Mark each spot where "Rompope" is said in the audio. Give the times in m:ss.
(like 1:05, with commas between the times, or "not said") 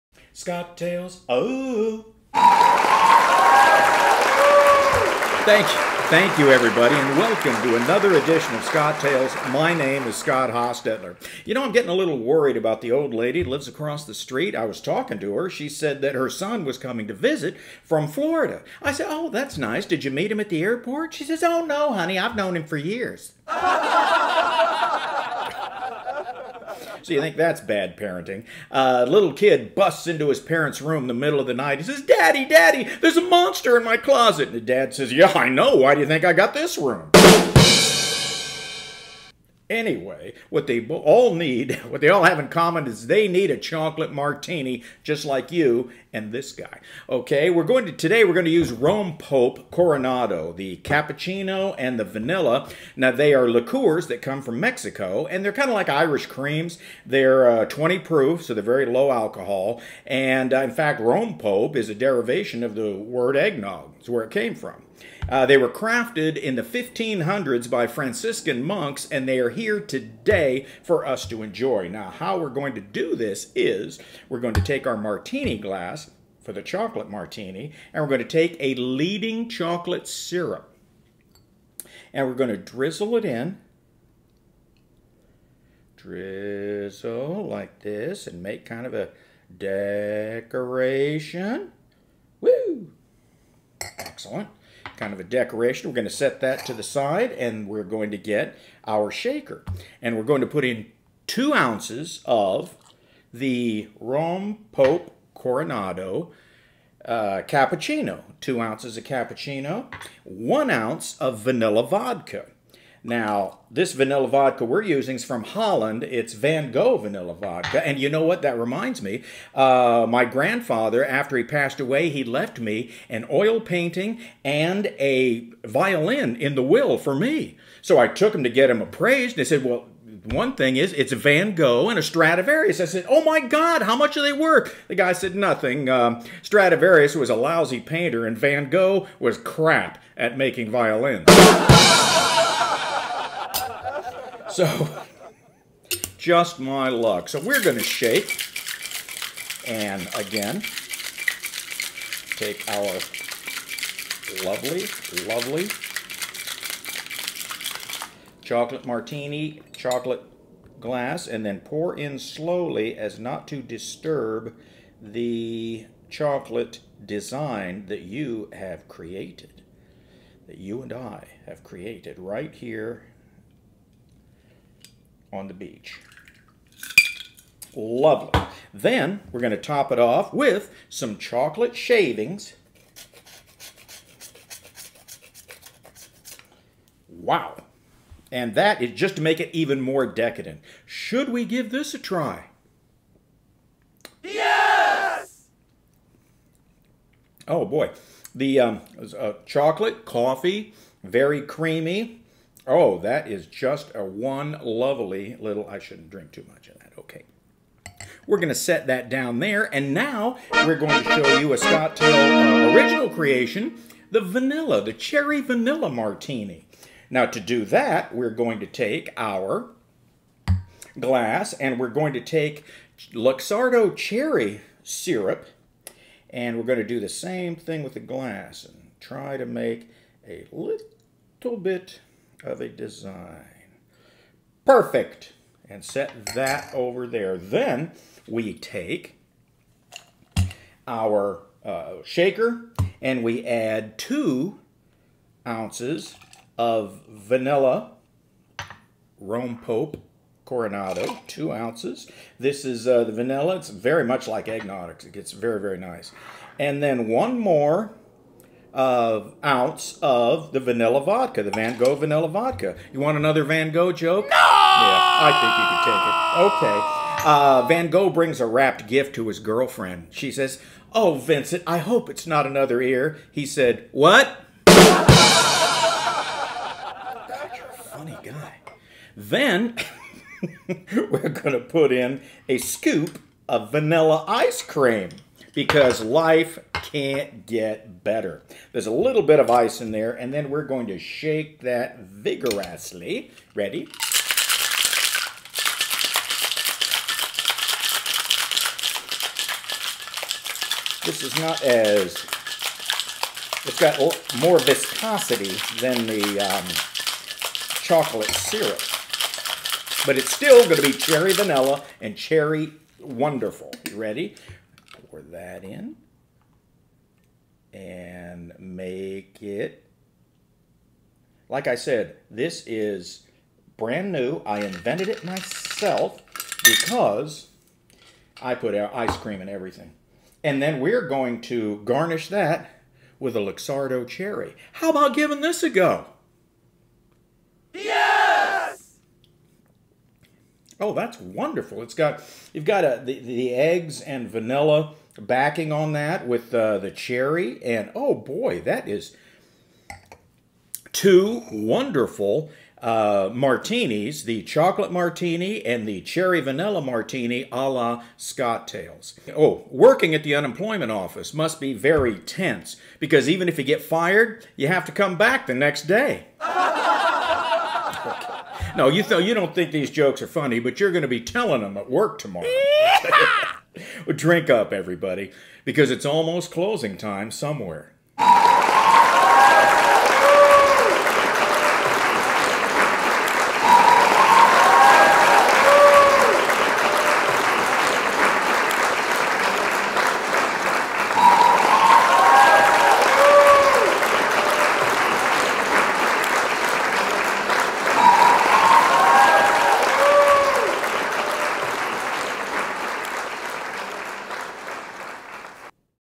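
0:48, 1:00, 1:43, 4:09.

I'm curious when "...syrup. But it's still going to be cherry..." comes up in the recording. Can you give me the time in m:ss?
5:08.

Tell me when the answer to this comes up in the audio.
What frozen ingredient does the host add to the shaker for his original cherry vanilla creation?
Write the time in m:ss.
4:43.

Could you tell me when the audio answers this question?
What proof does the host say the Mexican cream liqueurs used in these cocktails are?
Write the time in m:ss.
0:57.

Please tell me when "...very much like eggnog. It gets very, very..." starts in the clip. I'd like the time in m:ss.
4:13.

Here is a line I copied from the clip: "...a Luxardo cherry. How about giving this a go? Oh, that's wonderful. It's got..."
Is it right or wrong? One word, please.
right.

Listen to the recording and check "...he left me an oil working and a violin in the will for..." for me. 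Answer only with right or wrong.
wrong.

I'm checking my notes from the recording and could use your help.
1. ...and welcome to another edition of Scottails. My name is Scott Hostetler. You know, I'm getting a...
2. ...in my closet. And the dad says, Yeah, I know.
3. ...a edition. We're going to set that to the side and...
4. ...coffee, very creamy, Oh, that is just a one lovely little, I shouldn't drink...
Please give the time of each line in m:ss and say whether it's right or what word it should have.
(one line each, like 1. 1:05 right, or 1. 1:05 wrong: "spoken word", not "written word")
1. 0:06 right
2. 0:33 right
3. 1:35 wrong: "decoration", not "edition"
4. 3:20 right.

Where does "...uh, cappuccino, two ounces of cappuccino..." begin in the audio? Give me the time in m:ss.
1:47.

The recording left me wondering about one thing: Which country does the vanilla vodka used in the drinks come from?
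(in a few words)
Holland.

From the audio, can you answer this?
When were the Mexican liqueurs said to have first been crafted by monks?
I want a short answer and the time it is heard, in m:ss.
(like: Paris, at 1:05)
1500s, at 1:06.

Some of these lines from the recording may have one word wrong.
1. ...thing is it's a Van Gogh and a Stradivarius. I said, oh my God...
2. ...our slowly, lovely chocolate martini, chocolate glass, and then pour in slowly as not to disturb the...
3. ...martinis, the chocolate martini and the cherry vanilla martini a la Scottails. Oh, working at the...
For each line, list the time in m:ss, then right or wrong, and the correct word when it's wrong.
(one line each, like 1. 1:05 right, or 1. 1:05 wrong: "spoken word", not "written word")
1. 2:10 right
2. 2:32 wrong: "lovely", not "slowly"
3. 5:53 right.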